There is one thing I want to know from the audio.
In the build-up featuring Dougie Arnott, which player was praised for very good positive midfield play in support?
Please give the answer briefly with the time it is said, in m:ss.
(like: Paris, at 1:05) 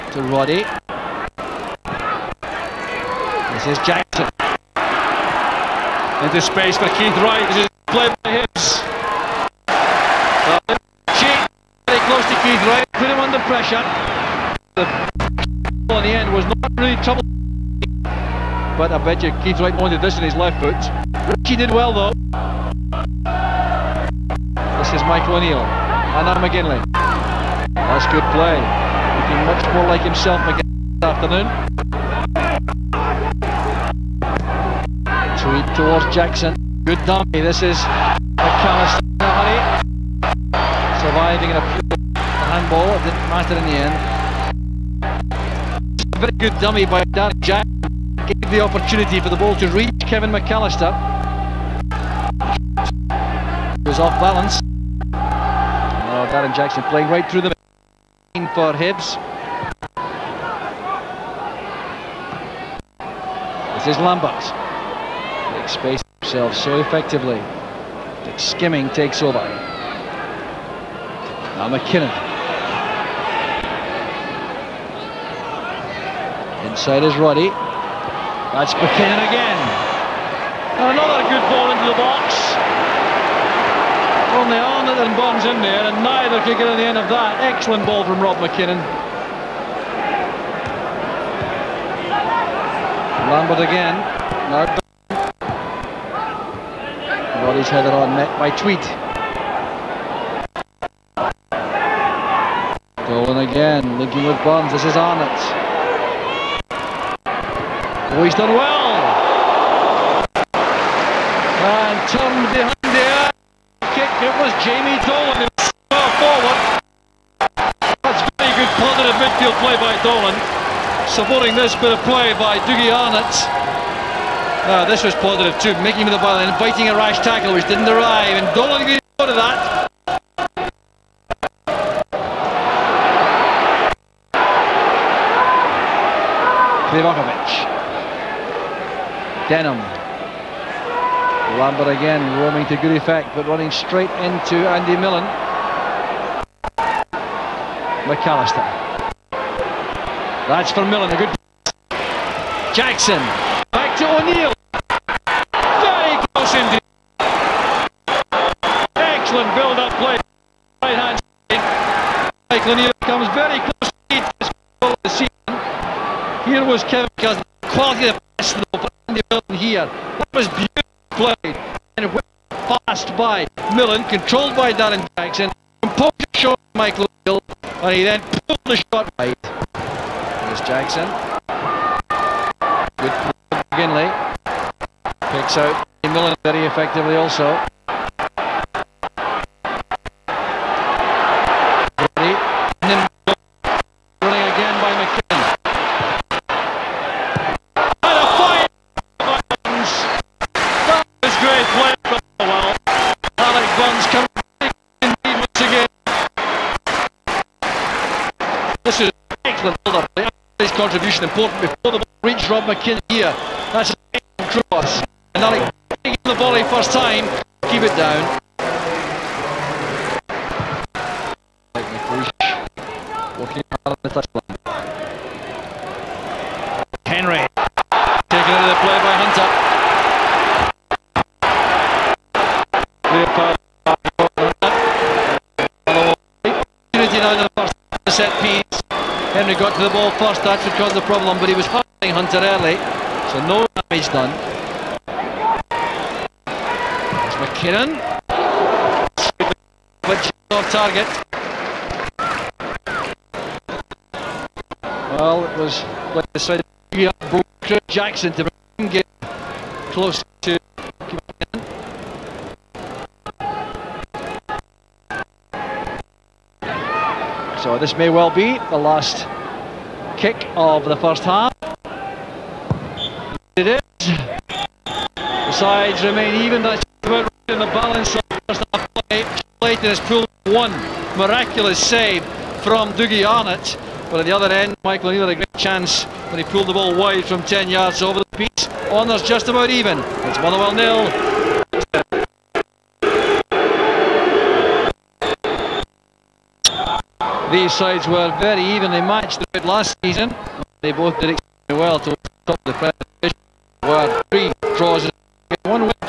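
Jamie Dolan, at 1:54.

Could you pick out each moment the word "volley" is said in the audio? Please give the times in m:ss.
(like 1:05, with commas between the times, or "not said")
3:36.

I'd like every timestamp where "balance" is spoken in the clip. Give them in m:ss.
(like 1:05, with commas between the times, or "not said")
0:54, 4:37.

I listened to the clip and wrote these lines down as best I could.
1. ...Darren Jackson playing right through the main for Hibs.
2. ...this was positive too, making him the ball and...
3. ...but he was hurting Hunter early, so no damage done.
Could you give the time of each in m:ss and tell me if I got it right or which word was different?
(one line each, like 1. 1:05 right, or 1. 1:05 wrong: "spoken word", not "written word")
1. 0:56 right
2. 2:04 right
3. 4:01 right.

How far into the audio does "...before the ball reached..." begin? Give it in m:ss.
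3:31.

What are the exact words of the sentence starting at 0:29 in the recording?
Looking much more like himself again this afternoon.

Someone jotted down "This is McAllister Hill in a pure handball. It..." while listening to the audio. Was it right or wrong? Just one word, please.
wrong.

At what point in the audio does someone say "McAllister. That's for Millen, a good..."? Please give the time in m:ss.
2:28.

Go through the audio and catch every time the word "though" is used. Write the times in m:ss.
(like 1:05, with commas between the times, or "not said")
0:21, 2:48.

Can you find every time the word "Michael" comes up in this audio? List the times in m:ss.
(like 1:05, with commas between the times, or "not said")
0:25, 2:42, 2:56, 4:44.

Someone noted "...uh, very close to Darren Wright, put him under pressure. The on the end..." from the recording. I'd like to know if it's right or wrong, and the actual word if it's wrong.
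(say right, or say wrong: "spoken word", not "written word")
wrong: "Keith", not "Darren".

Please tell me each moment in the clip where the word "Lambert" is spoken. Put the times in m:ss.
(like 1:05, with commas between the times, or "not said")
1:04, 1:33, 2:21.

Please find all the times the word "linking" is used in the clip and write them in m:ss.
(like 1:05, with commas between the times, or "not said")
1:43.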